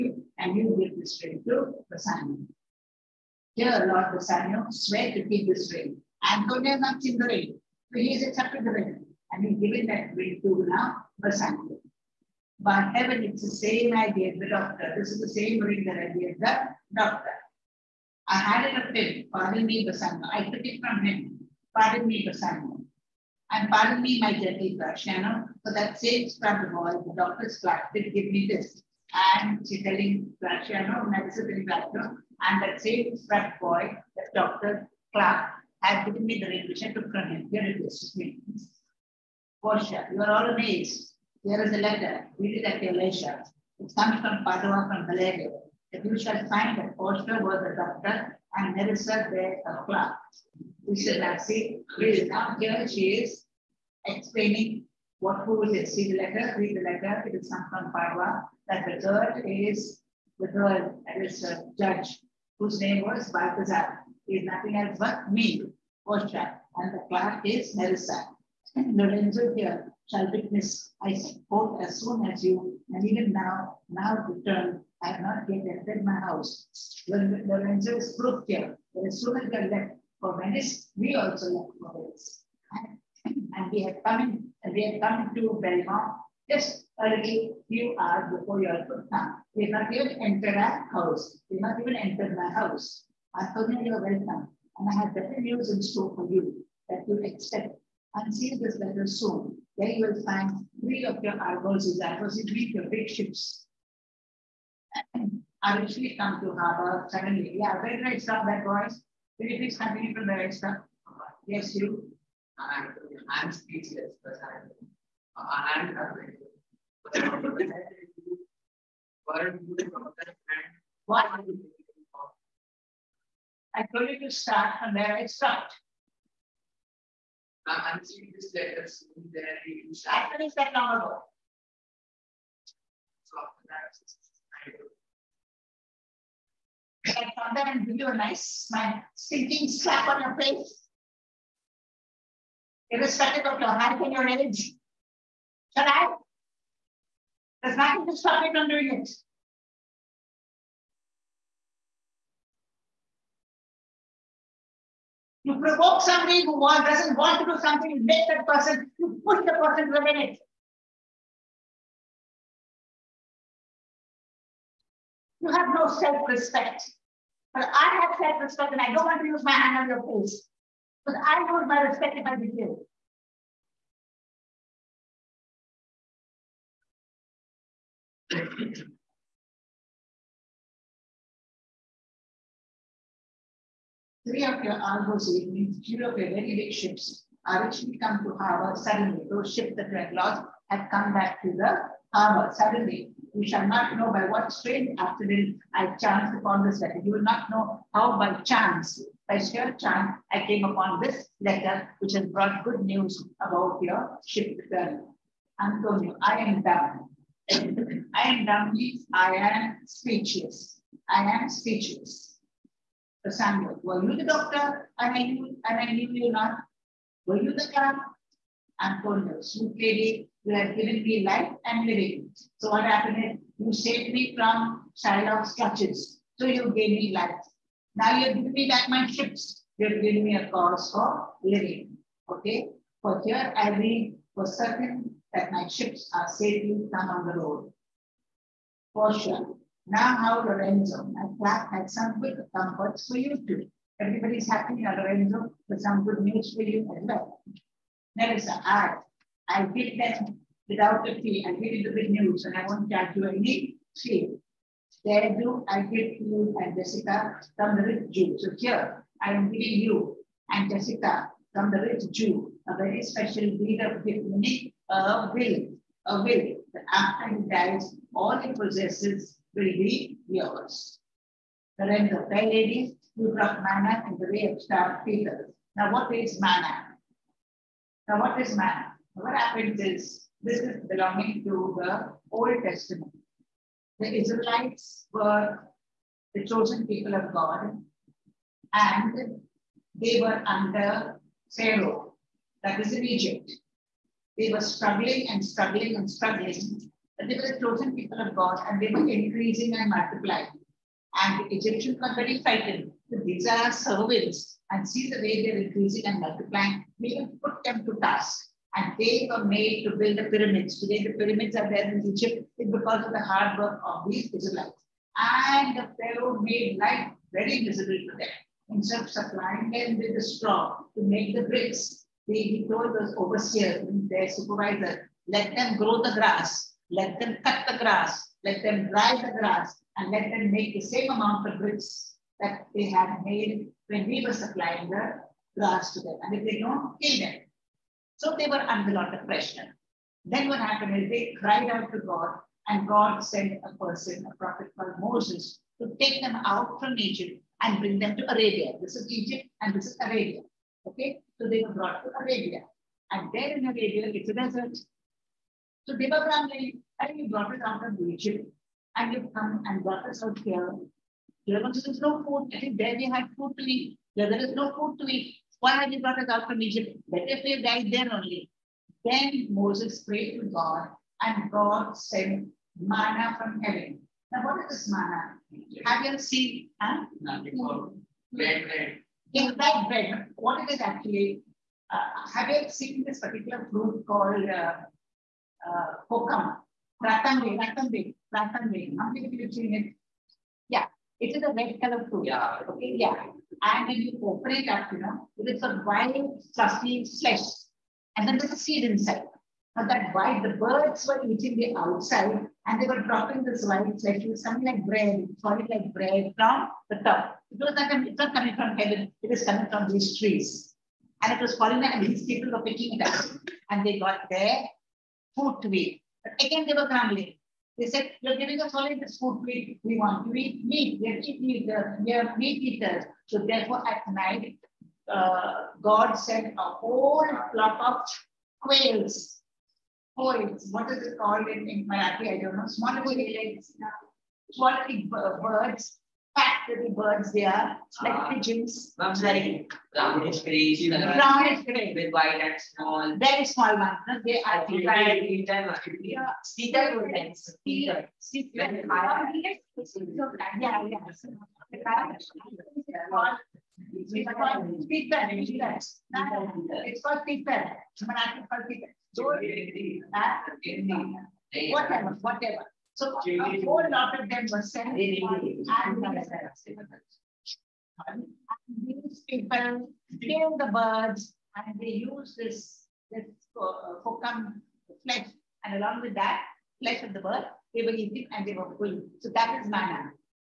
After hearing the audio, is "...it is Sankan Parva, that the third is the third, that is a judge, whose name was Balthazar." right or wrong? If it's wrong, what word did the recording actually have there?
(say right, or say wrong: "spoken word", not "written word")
right.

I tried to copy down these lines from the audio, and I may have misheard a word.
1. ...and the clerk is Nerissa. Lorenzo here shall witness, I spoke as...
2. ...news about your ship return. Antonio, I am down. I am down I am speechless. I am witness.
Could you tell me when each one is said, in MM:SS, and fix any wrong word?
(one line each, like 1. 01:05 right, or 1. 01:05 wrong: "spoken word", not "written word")
1. 01:06 right
2. 03:22 wrong: "speechless", not "witness".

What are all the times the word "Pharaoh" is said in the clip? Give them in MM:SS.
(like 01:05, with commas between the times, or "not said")
04:51, 05:15.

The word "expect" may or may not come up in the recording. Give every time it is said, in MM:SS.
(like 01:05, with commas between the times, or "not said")
01:37.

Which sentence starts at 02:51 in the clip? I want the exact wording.
Because I lose my respect if I behave.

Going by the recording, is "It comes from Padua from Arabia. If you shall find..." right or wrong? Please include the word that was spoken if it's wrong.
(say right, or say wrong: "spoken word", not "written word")
wrong: "Bellario", not "Arabia".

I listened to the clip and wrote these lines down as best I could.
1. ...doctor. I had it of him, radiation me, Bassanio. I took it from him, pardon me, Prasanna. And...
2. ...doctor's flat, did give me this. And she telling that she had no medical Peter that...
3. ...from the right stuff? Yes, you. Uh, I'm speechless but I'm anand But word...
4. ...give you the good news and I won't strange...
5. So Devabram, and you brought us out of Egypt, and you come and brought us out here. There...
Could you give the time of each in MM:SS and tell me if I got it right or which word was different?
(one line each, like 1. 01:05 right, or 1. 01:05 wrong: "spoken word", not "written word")
1. 00:16 wrong: "pardon", not "radiation"
2. 00:27 wrong: "And", not "Peter"
3. 01:50 right
4. 04:11 wrong: "charge", not "strange"
5. 05:55 right.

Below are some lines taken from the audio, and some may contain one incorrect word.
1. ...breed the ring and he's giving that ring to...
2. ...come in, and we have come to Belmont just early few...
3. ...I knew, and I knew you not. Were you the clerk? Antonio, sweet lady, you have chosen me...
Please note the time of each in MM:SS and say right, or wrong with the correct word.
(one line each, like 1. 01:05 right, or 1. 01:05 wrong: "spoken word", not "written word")
1. 00:08 wrong: "accepted", not "breed"
2. 01:24 right
3. 03:35 wrong: "given", not "chosen".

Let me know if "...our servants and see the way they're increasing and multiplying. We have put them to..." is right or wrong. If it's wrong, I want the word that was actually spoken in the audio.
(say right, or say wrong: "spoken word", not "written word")
right.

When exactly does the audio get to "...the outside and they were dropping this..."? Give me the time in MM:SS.
06:41.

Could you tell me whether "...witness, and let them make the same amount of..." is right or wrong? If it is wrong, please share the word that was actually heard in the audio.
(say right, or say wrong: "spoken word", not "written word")
wrong: "grass", not "witness".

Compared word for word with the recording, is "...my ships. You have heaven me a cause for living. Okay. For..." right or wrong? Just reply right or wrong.
wrong.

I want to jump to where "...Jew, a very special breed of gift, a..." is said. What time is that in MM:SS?
04:22.